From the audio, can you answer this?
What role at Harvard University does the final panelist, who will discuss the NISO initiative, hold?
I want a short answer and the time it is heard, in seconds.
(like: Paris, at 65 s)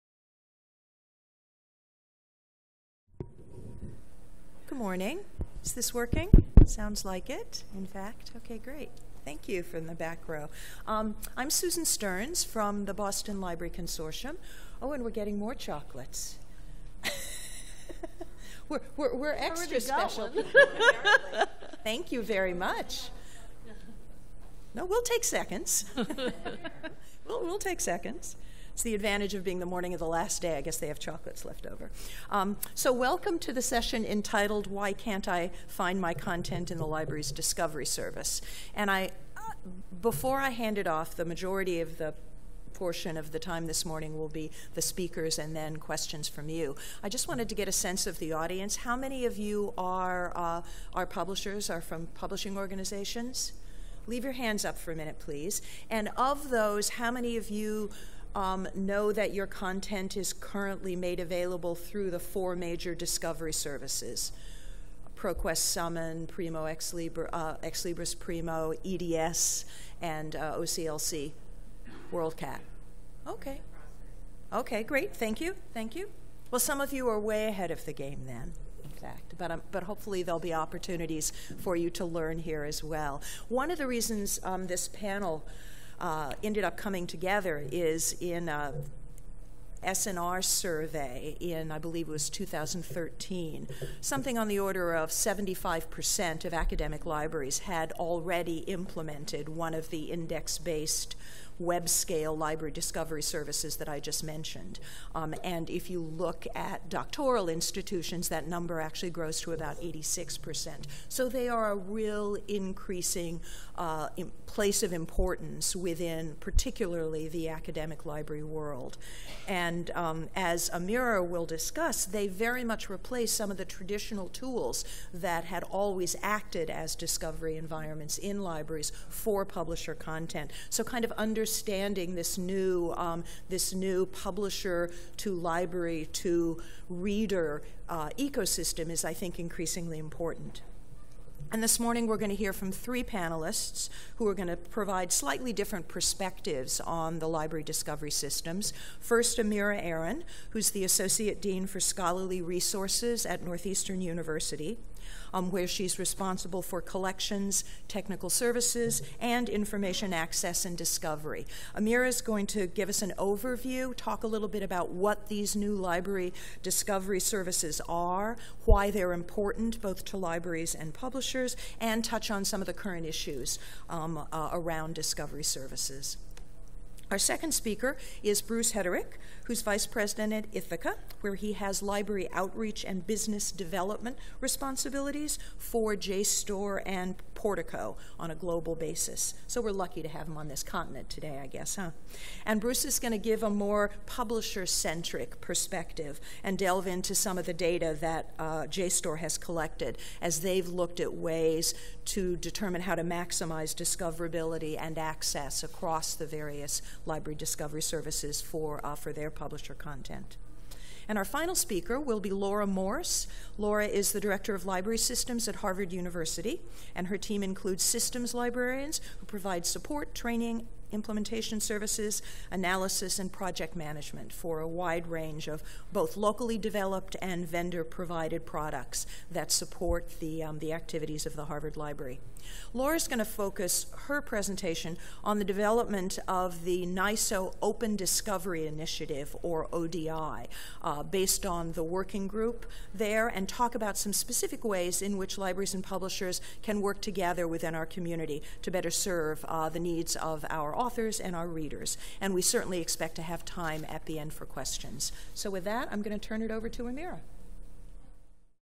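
Director of Library Systems, at 214 s.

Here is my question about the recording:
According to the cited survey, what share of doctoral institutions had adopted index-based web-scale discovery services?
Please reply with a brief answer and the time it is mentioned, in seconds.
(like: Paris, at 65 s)
86%, at 109 s.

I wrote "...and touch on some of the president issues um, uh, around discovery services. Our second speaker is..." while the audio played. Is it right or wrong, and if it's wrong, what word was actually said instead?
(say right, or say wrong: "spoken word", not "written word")
wrong: "current", not "president".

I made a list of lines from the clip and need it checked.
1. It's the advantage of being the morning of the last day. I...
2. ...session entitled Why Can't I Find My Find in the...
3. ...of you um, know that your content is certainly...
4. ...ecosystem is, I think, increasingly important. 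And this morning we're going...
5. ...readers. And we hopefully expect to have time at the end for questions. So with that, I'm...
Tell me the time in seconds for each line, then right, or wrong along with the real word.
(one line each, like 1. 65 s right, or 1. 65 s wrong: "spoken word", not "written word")
1. 28 s right
2. 33 s wrong: "Content", not "Find"
3. 57 s wrong: "currently", not "certainly"
4. 138 s right
5. 251 s wrong: "certainly", not "hopefully".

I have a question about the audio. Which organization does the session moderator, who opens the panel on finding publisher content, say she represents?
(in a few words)
Boston Library Consortium.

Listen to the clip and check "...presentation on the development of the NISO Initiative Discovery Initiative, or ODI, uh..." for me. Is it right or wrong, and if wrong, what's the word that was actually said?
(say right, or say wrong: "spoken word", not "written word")
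wrong: "Open", not "Initiative".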